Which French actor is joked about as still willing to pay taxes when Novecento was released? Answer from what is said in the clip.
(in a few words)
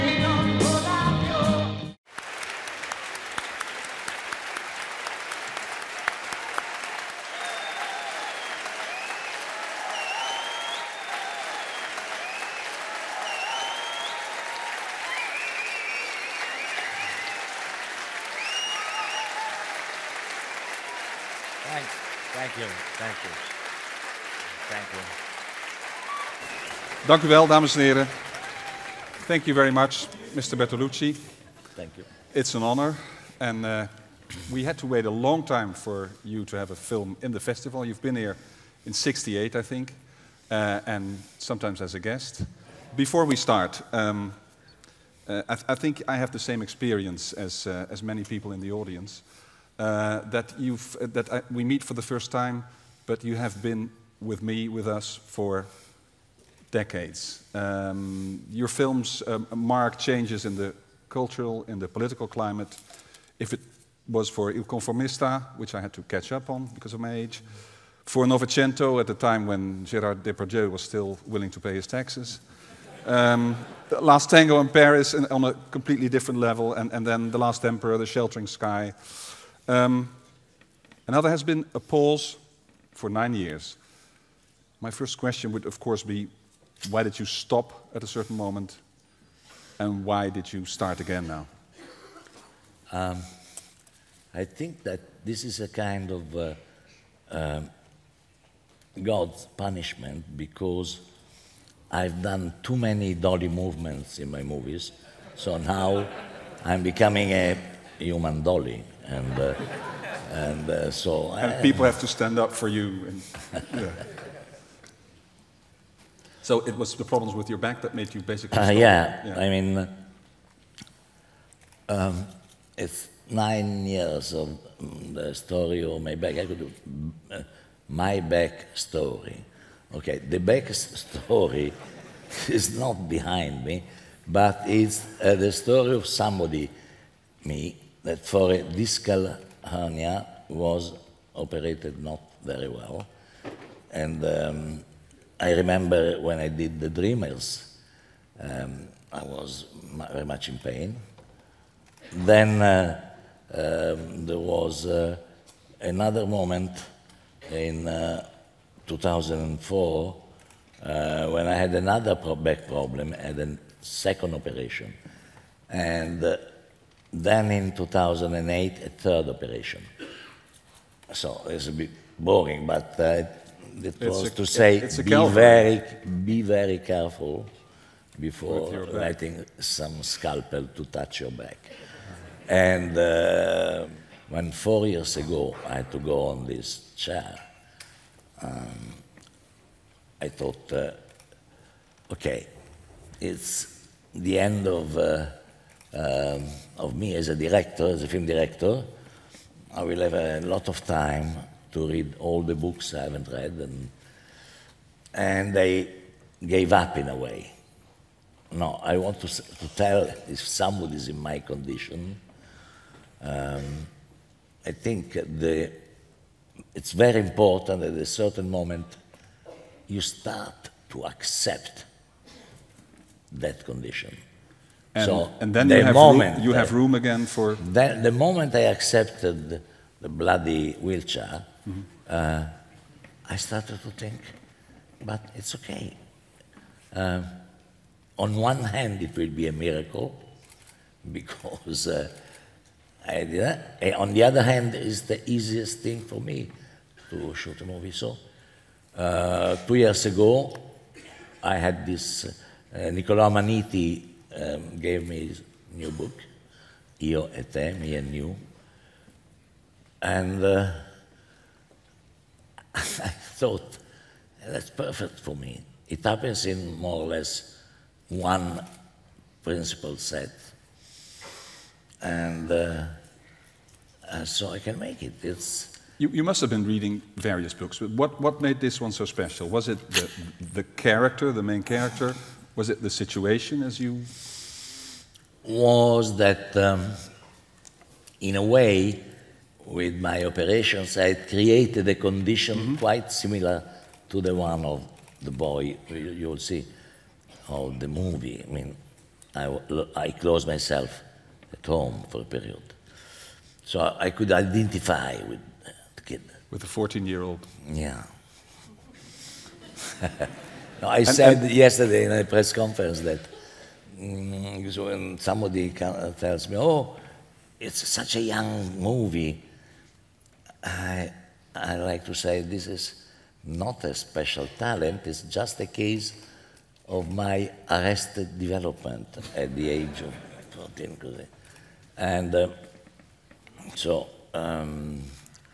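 Gerard Depardieu.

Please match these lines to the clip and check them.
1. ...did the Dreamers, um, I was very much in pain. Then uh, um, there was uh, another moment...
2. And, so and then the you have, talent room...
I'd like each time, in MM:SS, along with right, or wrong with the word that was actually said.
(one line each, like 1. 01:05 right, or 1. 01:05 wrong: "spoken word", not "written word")
1. 02:26 right
2. 03:44 wrong: "moment", not "talent".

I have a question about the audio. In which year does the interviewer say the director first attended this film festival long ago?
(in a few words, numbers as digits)
1968.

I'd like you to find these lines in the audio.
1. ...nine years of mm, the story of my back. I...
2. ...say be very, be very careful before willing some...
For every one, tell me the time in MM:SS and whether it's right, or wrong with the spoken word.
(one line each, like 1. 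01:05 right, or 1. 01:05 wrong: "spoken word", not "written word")
1. 02:03 right
2. 02:54 wrong: "letting", not "willing".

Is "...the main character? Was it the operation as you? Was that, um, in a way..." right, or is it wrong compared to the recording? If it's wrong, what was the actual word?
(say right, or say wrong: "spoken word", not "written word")
wrong: "situation", not "operation".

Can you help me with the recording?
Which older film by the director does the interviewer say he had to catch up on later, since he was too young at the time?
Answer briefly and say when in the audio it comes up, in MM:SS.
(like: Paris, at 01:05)
Il Conformista, at 01:04.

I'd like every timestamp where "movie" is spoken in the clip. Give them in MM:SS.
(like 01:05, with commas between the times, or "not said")
01:44, 04:07, 04:57, 05:18.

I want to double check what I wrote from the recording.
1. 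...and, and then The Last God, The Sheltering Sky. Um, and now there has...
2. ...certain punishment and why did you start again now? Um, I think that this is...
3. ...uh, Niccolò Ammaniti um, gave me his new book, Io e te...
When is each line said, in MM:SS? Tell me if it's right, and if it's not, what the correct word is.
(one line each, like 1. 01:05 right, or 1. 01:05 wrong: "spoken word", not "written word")
1. 01:16 wrong: "Emperor", not "God"
2. 01:28 wrong: "moment", not "punishment"
3. 04:12 right.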